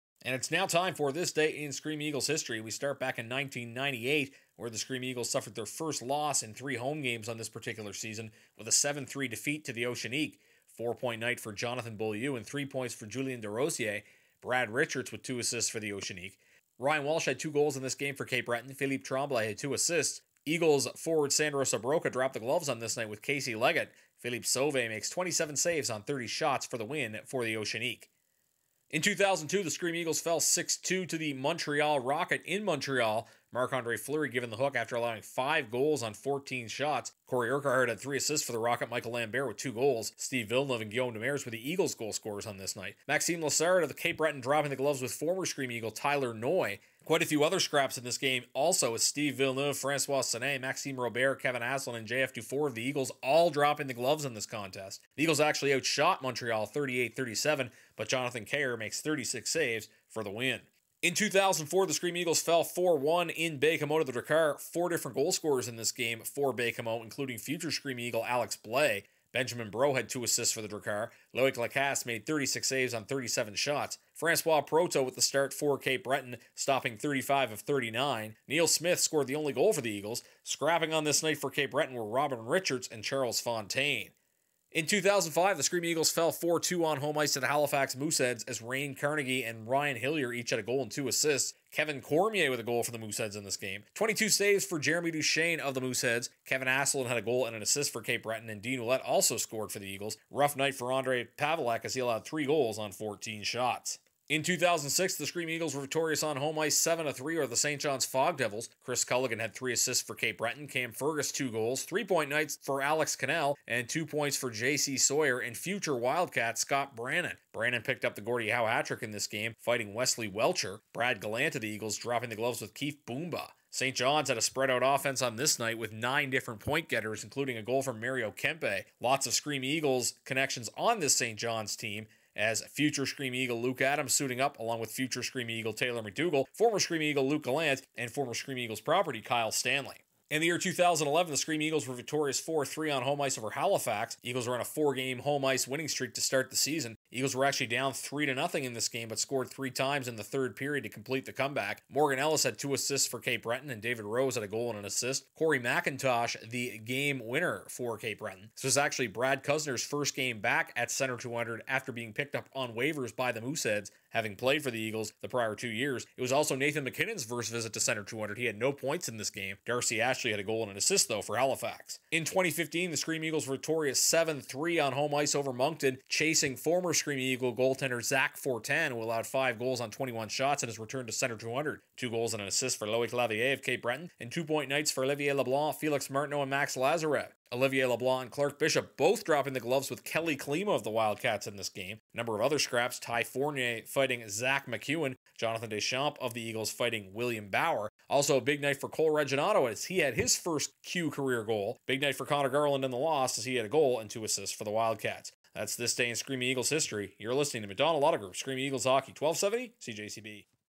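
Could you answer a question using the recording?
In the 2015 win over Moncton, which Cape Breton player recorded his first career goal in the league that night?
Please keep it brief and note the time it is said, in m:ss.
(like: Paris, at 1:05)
Cole Reginato, at 3:18.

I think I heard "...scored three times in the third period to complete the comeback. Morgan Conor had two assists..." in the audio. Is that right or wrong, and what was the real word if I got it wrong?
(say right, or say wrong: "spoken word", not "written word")
wrong: "Ellis", not "Conor".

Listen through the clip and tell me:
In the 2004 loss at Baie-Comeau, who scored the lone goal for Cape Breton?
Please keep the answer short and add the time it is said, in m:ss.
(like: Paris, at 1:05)
Neil Smith, at 1:18.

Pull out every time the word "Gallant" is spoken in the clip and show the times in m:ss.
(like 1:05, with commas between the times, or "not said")
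2:01, 2:17.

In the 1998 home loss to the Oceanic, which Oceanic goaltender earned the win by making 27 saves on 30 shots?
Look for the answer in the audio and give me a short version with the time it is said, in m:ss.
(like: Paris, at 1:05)
Philippe Sauve, at 0:24.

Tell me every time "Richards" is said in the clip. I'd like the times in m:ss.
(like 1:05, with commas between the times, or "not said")
0:14, 1:22.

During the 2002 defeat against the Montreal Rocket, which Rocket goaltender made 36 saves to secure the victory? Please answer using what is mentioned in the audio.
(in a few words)
Jonathan Kerr.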